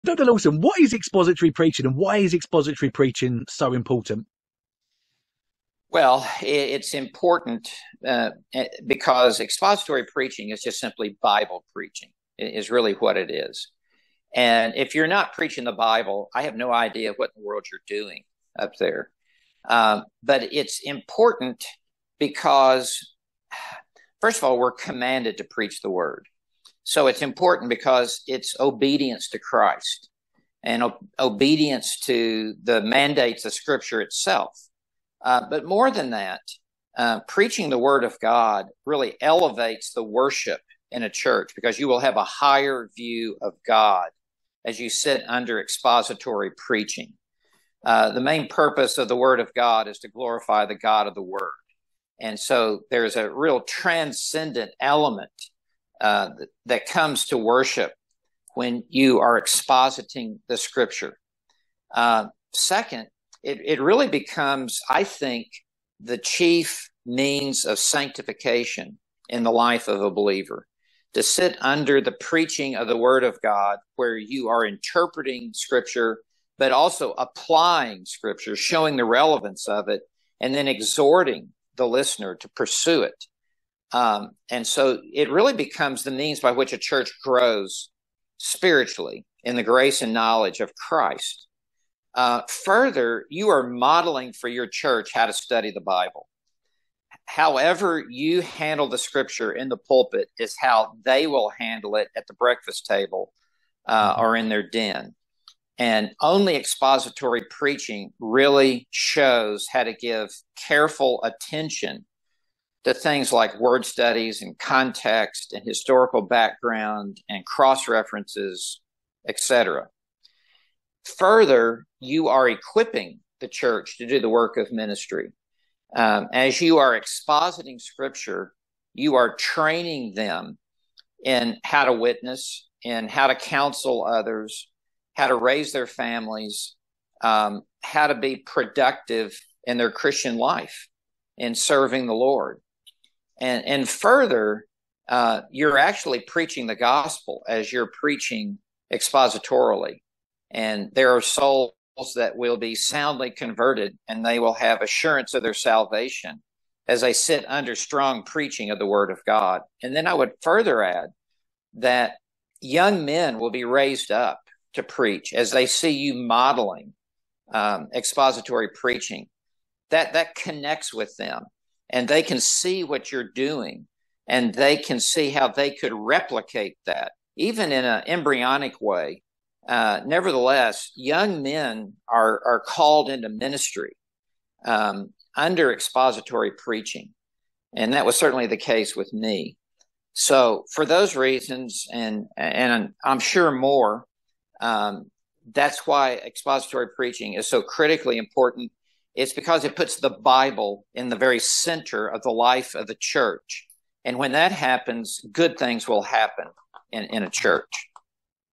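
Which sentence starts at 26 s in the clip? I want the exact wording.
So it's important because it's obedience to Christ and o- obedience to the mandates of Scripture itself.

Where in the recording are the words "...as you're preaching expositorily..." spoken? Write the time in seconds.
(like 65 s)
147 s.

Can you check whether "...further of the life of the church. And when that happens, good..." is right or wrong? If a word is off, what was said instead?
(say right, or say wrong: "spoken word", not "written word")
wrong: "center", not "further".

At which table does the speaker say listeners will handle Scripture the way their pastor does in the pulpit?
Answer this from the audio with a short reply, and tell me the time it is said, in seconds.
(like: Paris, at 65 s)
Breakfast table, at 102 s.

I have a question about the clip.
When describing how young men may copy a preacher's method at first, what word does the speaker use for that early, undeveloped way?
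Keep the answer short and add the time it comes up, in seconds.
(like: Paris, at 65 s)
Embryonic, at 178 s.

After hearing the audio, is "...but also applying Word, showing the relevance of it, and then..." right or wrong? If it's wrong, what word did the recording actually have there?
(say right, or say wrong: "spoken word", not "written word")
wrong: "Scripture", not "Word".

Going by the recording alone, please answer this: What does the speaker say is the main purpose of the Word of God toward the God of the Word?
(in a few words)
Glorify.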